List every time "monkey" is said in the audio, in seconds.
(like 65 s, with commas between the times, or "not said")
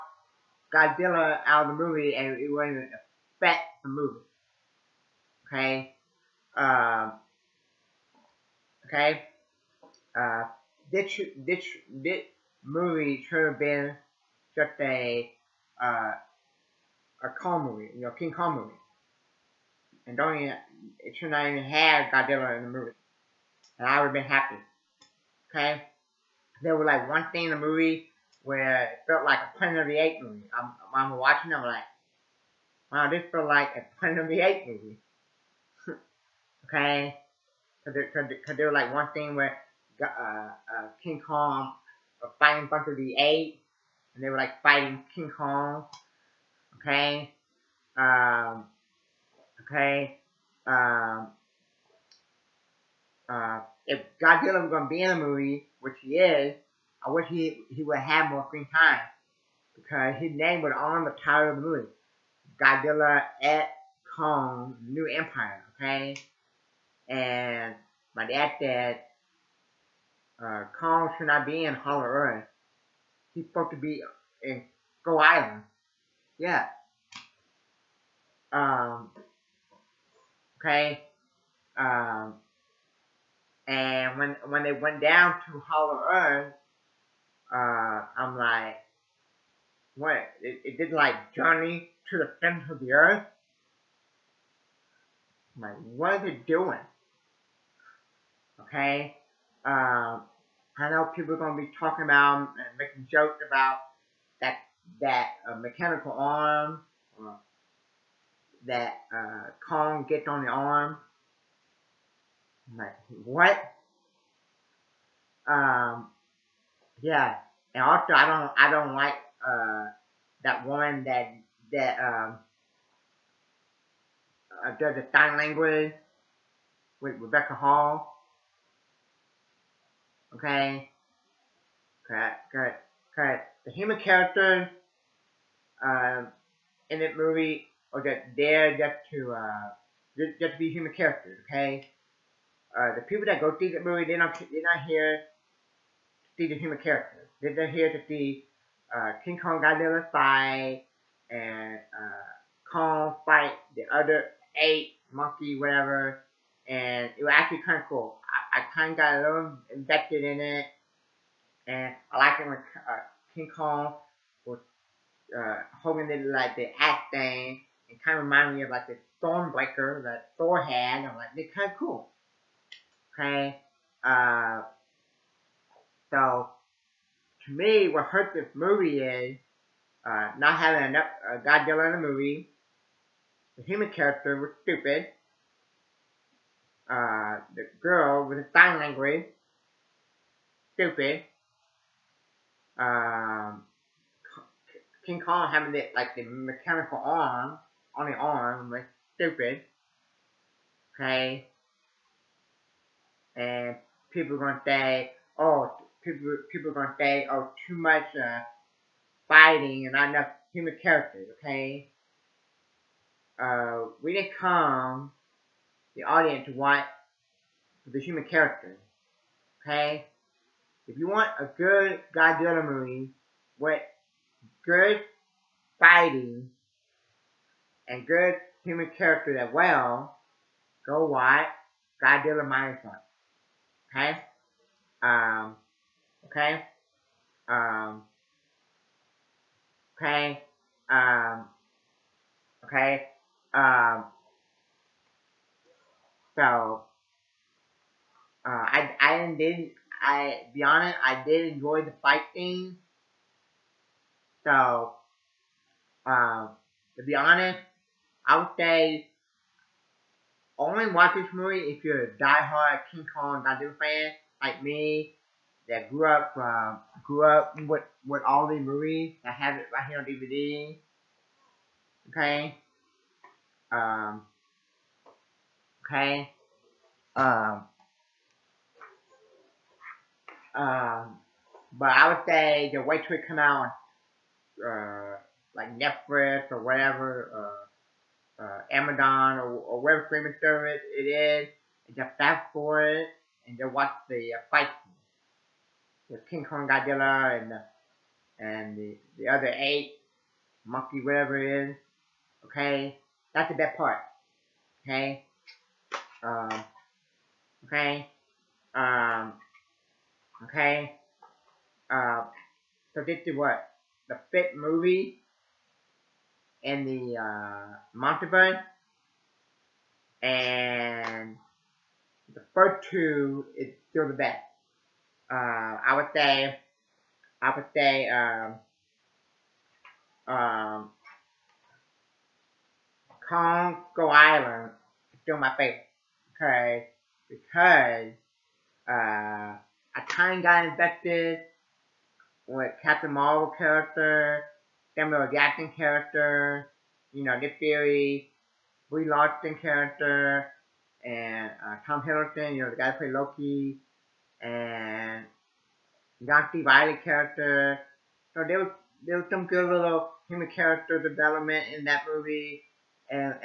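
155 s, 300 s.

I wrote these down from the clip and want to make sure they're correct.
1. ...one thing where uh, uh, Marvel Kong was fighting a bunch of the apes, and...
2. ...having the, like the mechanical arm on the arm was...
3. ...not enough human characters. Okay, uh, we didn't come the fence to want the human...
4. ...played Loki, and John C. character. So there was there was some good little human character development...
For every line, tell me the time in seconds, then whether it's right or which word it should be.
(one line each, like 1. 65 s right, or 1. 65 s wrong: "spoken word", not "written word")
1. 38 s wrong: "King", not "Marvel"
2. 195 s right
3. 209 s wrong: "audience", not "fence"
4. 352 s right.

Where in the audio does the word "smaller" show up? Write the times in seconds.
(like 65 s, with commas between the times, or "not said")
not said.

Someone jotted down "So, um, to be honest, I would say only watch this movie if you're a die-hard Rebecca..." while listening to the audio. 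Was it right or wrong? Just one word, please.
wrong.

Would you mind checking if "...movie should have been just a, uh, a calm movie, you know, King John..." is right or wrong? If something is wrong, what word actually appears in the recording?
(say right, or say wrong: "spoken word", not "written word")
wrong: "Kong", not "John".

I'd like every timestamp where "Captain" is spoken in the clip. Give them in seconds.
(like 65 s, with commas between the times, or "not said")
342 s.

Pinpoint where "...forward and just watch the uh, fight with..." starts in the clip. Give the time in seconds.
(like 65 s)
292 s.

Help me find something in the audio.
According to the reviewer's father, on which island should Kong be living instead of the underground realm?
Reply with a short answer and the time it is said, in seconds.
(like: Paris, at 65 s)
Go Island, at 75 s.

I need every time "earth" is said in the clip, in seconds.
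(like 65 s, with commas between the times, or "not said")
72 s, 86 s, 92 s.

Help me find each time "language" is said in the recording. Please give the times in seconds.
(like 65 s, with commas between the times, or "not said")
125 s, 188 s.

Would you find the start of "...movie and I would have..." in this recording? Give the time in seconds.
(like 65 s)
22 s.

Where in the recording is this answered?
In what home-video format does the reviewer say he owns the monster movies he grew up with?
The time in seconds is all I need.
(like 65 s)
270 s.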